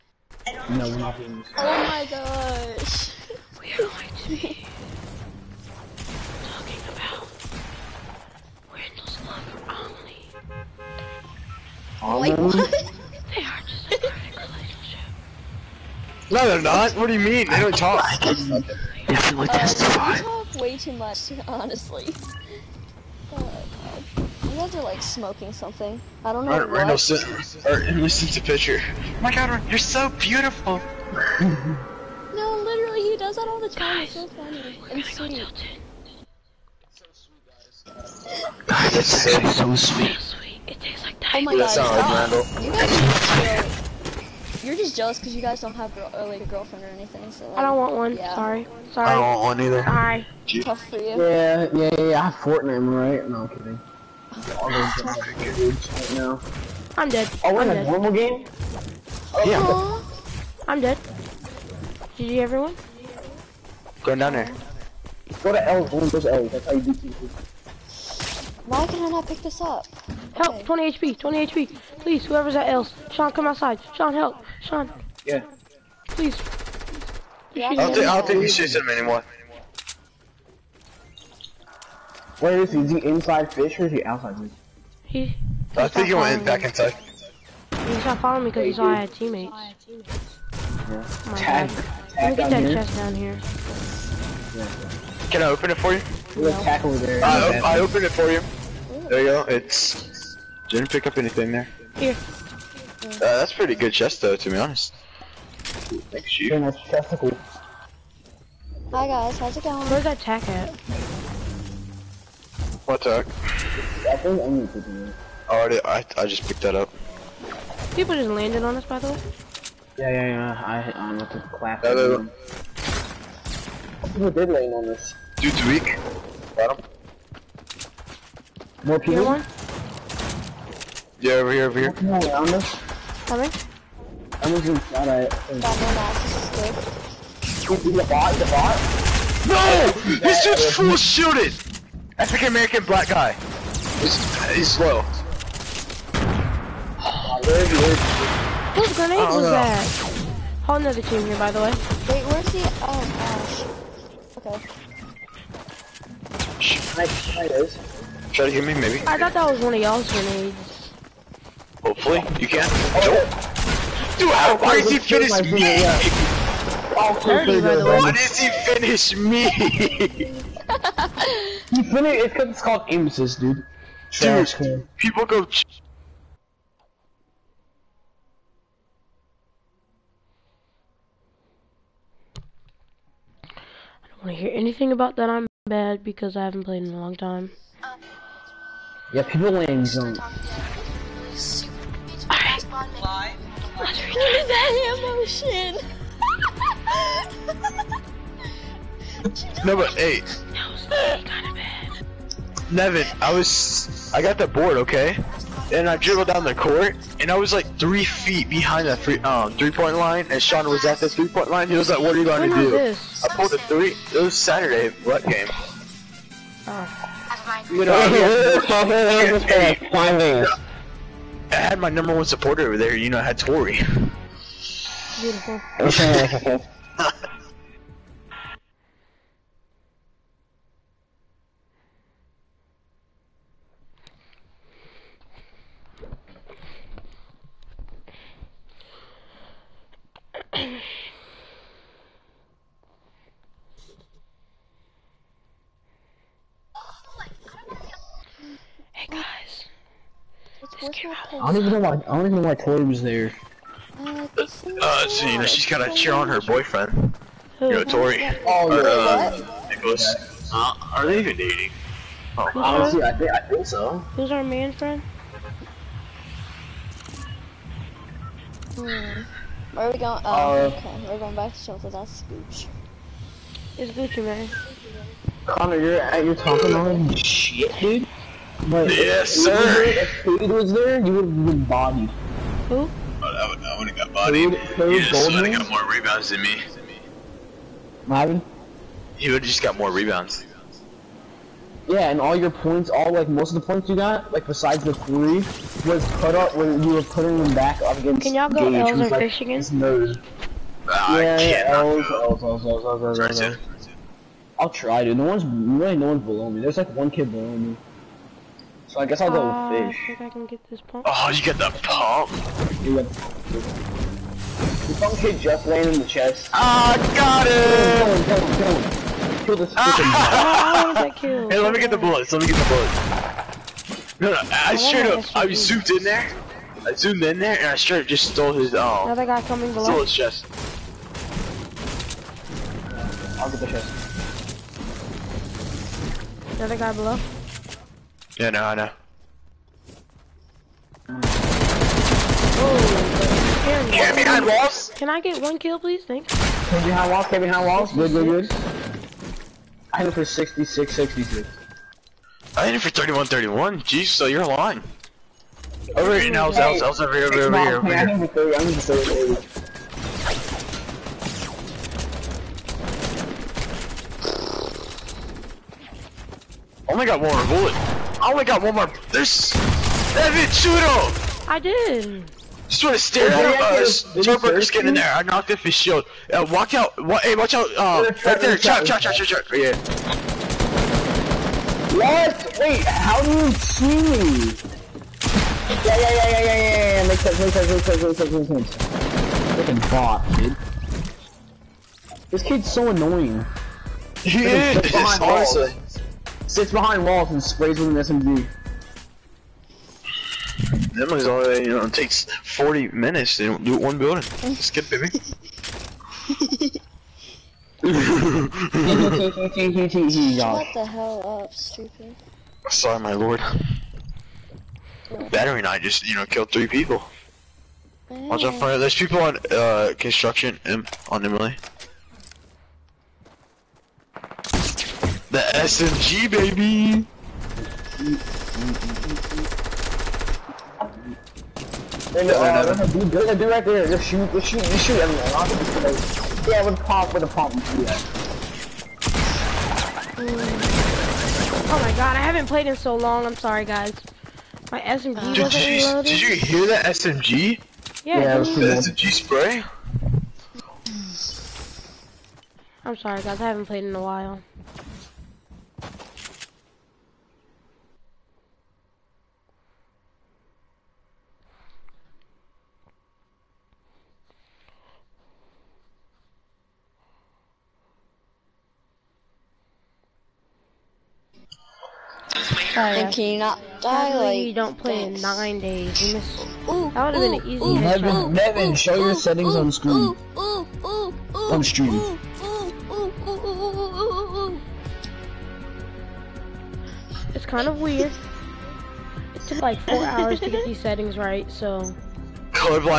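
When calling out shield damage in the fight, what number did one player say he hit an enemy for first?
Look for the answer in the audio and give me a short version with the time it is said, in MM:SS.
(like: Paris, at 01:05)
66, at 05:50.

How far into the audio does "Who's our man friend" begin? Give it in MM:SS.
04:24.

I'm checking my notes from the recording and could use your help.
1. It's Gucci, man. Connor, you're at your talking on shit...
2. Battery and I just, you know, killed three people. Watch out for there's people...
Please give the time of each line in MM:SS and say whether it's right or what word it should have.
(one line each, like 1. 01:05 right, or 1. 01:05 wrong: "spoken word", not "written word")
1. 04:33 right
2. 06:55 right.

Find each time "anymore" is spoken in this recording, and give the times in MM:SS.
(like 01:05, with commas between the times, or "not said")
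01:18.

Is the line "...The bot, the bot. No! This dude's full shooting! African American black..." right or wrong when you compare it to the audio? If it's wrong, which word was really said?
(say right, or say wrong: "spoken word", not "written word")
right.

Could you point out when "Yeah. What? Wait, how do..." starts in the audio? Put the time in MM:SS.
06:19.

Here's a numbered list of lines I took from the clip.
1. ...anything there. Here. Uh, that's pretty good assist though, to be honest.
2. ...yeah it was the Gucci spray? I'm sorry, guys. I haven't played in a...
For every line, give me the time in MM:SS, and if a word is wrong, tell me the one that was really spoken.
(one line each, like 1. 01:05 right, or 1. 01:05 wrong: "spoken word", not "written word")
1. 01:41 wrong: "chest", not "assist"
2. 07:28 wrong: "SMG", not "Gucci".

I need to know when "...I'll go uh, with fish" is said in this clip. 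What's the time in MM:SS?
05:09.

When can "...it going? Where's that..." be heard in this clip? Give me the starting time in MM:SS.
01:49.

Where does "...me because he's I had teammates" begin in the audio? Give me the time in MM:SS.
01:28.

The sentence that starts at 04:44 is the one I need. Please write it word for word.
Cade, Cade would have got more rebounds than me.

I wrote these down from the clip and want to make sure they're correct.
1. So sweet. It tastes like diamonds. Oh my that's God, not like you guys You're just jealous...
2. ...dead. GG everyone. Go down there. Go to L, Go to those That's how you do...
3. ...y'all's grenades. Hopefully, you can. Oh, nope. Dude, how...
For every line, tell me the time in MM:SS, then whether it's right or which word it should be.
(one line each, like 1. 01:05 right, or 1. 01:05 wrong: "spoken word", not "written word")
1. 00:39 right
2. 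01:00 right
3. 02:39 right.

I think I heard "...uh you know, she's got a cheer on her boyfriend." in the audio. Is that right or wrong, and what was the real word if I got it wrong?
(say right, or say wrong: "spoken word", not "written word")
right.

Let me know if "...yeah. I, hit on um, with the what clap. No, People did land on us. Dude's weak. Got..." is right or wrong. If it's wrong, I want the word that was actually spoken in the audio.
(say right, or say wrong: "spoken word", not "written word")
right.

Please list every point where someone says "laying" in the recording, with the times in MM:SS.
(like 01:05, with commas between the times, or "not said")
05:15.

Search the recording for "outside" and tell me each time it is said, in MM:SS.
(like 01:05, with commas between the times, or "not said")
01:13, 01:24.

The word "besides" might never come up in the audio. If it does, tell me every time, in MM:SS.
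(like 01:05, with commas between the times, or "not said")
04:54.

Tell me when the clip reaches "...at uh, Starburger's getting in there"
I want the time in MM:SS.
06:13.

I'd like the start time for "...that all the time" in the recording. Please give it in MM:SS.
00:33.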